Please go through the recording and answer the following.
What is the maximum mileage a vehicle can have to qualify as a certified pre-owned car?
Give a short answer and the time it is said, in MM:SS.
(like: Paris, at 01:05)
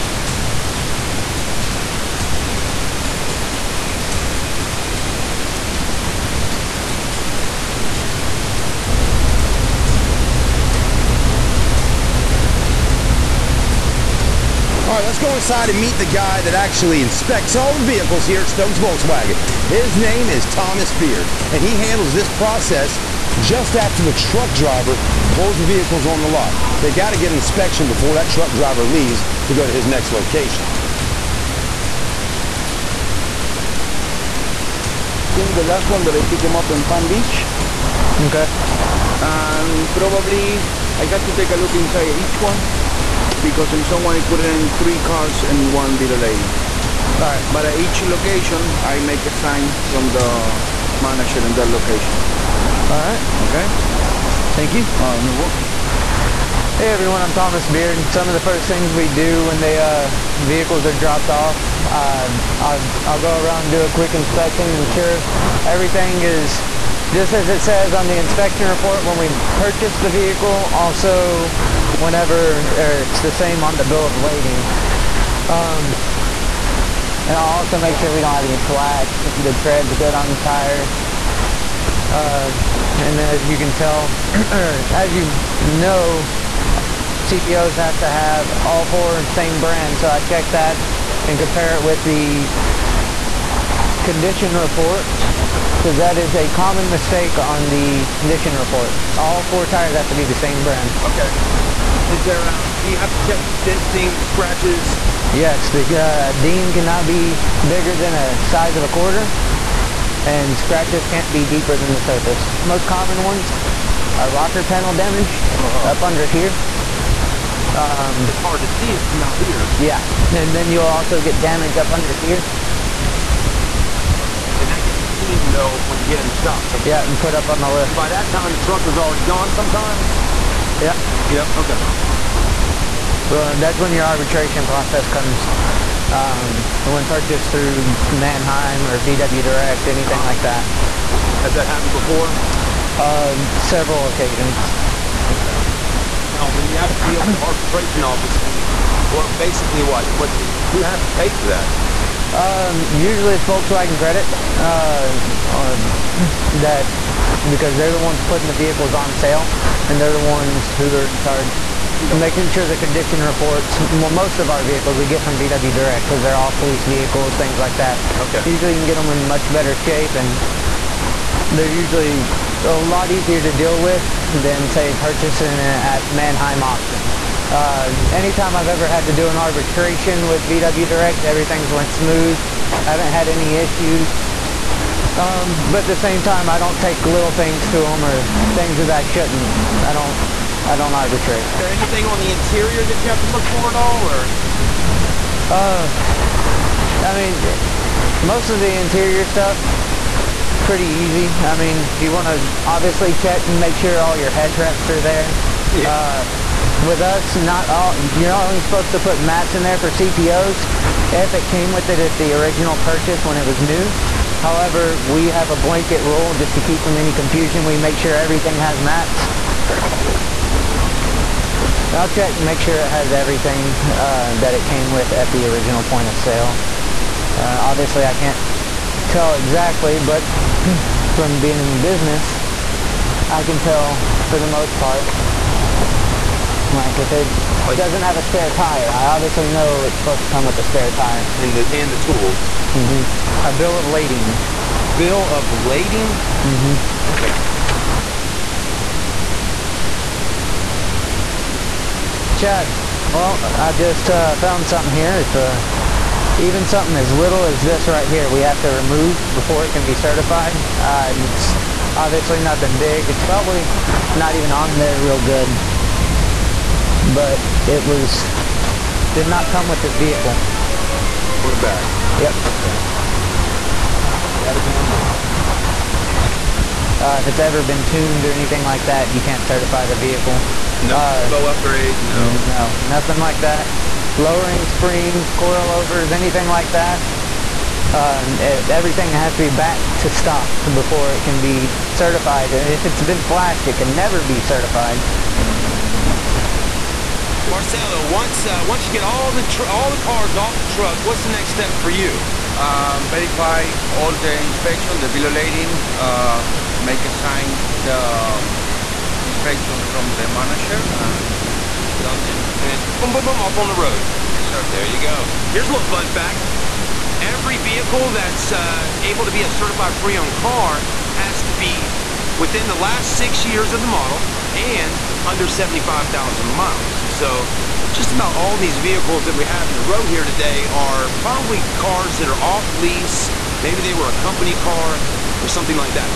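75,000 miles, at 05:25.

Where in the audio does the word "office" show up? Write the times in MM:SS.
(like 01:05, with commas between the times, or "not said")
02:28.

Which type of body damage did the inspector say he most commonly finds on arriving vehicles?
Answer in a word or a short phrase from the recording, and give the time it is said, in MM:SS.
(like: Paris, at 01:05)
rocker panel damage, at 01:54.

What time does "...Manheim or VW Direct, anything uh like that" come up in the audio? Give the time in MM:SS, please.
02:18.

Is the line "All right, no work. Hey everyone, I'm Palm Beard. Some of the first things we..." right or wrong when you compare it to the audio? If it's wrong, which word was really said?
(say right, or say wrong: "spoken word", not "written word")
wrong: "Thomas", not "Palm".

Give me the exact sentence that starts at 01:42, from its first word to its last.
Is there, uh, do you have to check dings, scratches?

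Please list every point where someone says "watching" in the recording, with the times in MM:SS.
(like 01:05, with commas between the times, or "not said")
not said.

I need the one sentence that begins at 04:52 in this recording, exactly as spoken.
And if it's been flashed, it can never be certified.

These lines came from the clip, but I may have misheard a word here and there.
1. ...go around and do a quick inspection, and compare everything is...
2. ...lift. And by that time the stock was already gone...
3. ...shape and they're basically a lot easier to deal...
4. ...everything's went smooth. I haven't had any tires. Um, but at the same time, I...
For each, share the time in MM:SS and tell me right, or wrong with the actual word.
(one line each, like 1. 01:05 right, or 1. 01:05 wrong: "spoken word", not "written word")
1. 01:03 wrong: "ensure", not "compare"
2. 02:07 wrong: "truck", not "stock"
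3. 02:49 wrong: "usually", not "basically"
4. 03:01 wrong: "issues", not "tires".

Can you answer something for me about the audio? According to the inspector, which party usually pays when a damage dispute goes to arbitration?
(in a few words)
Volkswagen Credit.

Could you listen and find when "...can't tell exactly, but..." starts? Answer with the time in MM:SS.
03:48.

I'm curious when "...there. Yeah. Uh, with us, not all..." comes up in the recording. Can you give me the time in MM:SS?
03:25.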